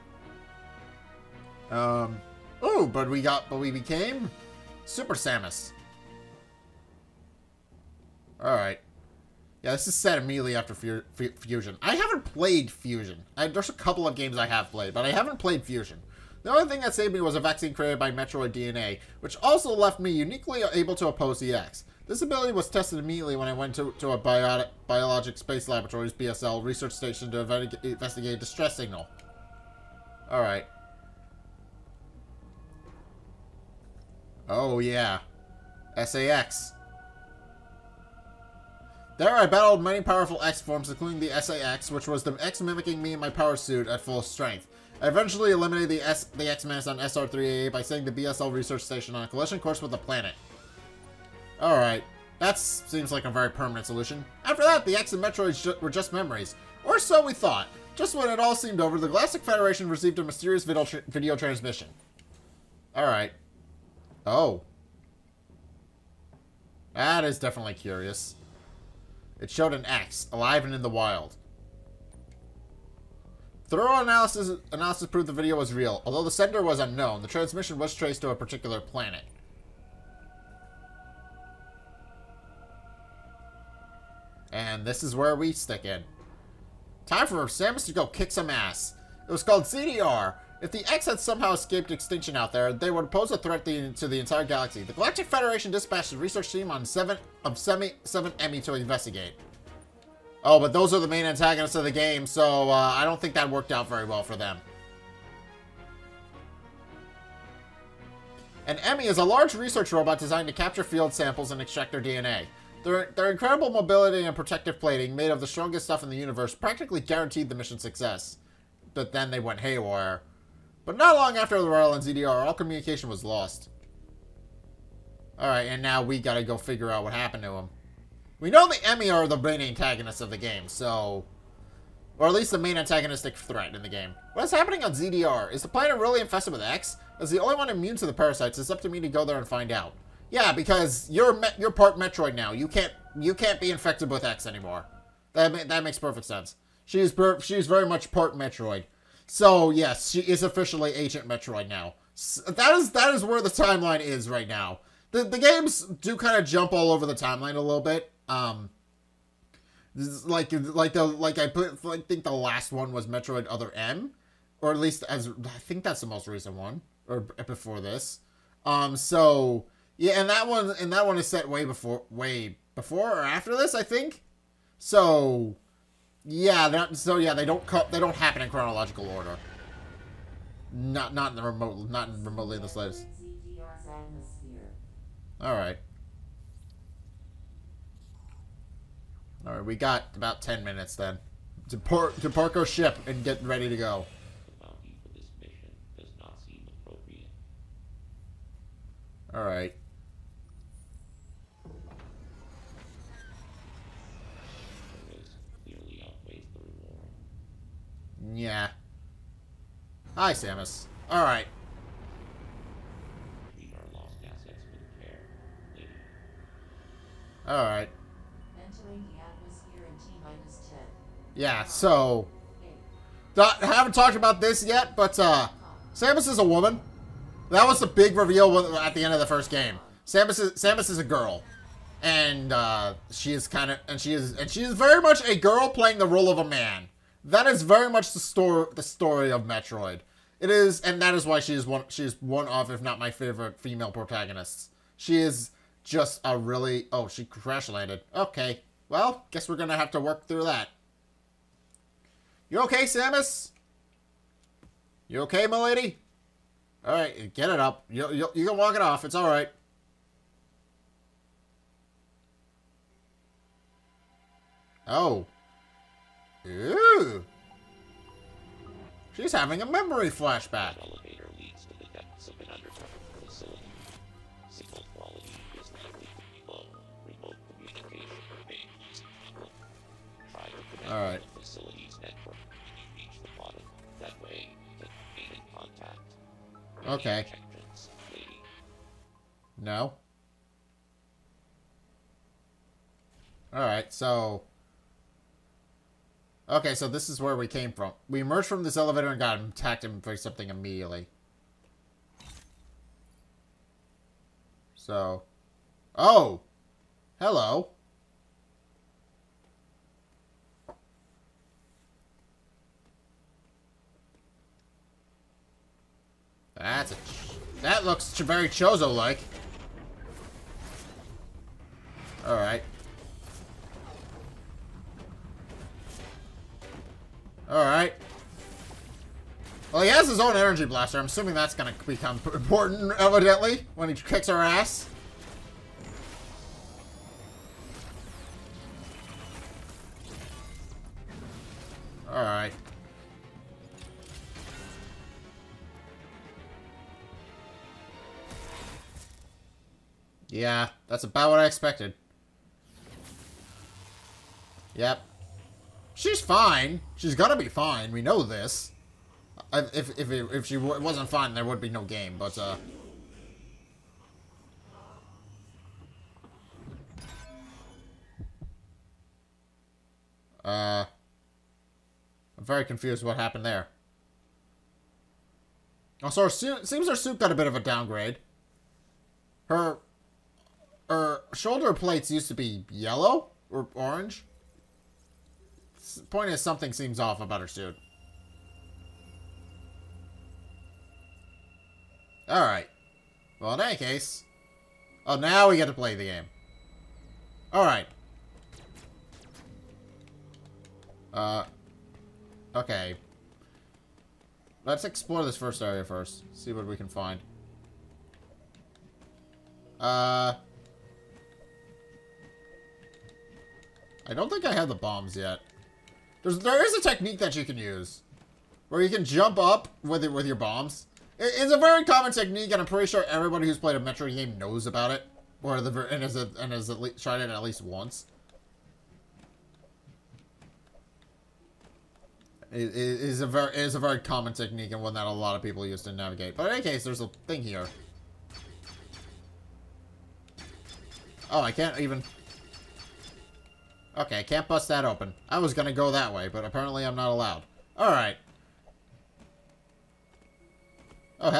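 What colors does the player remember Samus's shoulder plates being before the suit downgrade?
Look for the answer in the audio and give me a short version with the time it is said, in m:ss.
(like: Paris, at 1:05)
yellow or orange, at 6:22.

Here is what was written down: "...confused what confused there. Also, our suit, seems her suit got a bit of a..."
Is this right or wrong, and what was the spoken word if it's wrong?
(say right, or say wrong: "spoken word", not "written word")
wrong: "happened", not "confused".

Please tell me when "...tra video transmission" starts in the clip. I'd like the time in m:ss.
1:00.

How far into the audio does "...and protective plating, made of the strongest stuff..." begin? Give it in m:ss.
1:54.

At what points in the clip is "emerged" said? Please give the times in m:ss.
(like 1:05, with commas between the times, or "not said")
4:58.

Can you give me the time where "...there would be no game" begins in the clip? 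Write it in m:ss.
6:01.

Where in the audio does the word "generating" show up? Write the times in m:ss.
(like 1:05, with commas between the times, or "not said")
not said.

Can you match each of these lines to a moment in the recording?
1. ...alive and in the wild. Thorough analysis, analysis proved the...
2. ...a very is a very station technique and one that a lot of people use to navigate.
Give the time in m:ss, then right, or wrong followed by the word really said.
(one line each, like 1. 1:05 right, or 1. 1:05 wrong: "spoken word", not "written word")
1. 1:10 right
2. 7:13 wrong: "common", not "station".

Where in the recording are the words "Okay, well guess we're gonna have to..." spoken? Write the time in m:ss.
4:08.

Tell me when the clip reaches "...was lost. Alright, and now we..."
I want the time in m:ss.
2:03.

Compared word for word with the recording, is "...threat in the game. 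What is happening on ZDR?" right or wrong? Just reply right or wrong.
right.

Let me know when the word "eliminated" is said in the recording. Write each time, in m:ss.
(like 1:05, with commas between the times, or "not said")
0:45.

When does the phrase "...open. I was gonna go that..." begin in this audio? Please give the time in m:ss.
7:24.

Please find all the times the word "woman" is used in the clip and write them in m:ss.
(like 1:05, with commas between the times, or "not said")
3:46.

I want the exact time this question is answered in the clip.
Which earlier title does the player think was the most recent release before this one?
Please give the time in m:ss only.
2:43.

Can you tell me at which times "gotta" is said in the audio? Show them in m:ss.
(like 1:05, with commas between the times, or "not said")
2:06, 5:57.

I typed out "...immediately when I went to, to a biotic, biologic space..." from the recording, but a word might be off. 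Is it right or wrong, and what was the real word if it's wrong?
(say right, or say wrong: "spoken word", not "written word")
right.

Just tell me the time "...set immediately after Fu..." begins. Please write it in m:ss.
0:09.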